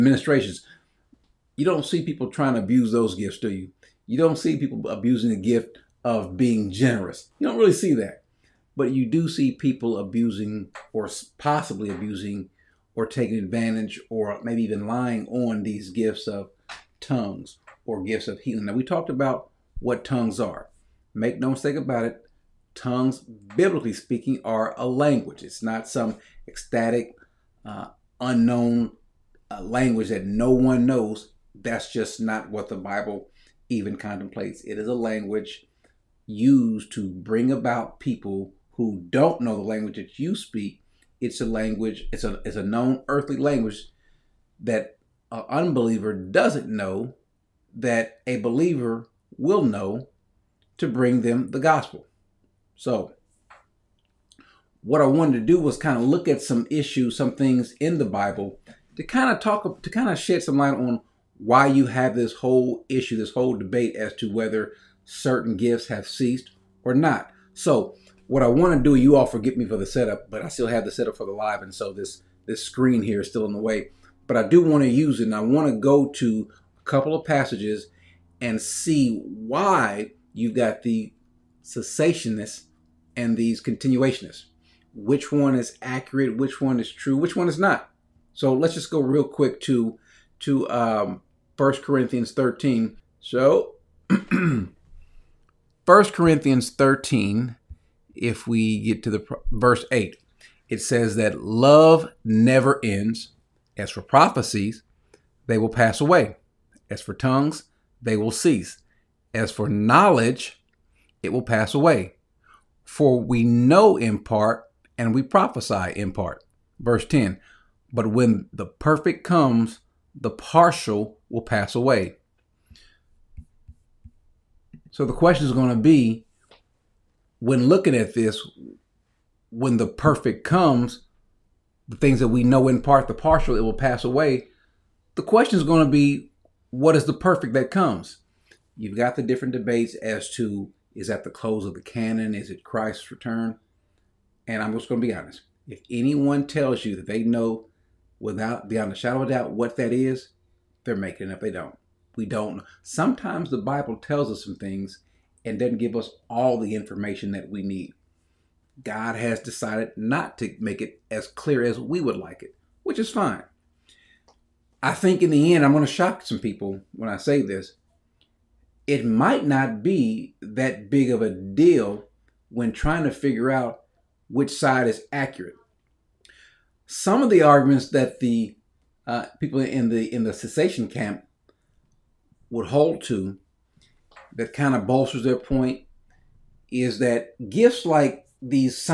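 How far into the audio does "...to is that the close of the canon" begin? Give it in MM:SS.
02:20.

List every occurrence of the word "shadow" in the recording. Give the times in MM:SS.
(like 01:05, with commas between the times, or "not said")
02:28.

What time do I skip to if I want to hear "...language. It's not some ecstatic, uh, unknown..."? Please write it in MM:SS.
00:24.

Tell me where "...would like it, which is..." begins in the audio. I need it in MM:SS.
02:41.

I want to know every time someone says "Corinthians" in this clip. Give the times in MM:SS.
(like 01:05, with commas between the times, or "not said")
01:31, 01:35.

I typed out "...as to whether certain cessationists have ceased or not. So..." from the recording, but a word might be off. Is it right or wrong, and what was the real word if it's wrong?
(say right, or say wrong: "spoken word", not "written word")
wrong: "gifts", not "cessationists".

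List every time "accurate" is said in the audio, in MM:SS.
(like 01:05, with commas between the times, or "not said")
01:25, 02:55.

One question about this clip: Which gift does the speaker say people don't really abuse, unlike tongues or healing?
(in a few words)
Being generous.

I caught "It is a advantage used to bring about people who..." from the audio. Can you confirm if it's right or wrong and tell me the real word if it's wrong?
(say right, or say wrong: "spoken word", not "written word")
wrong: "language", not "advantage".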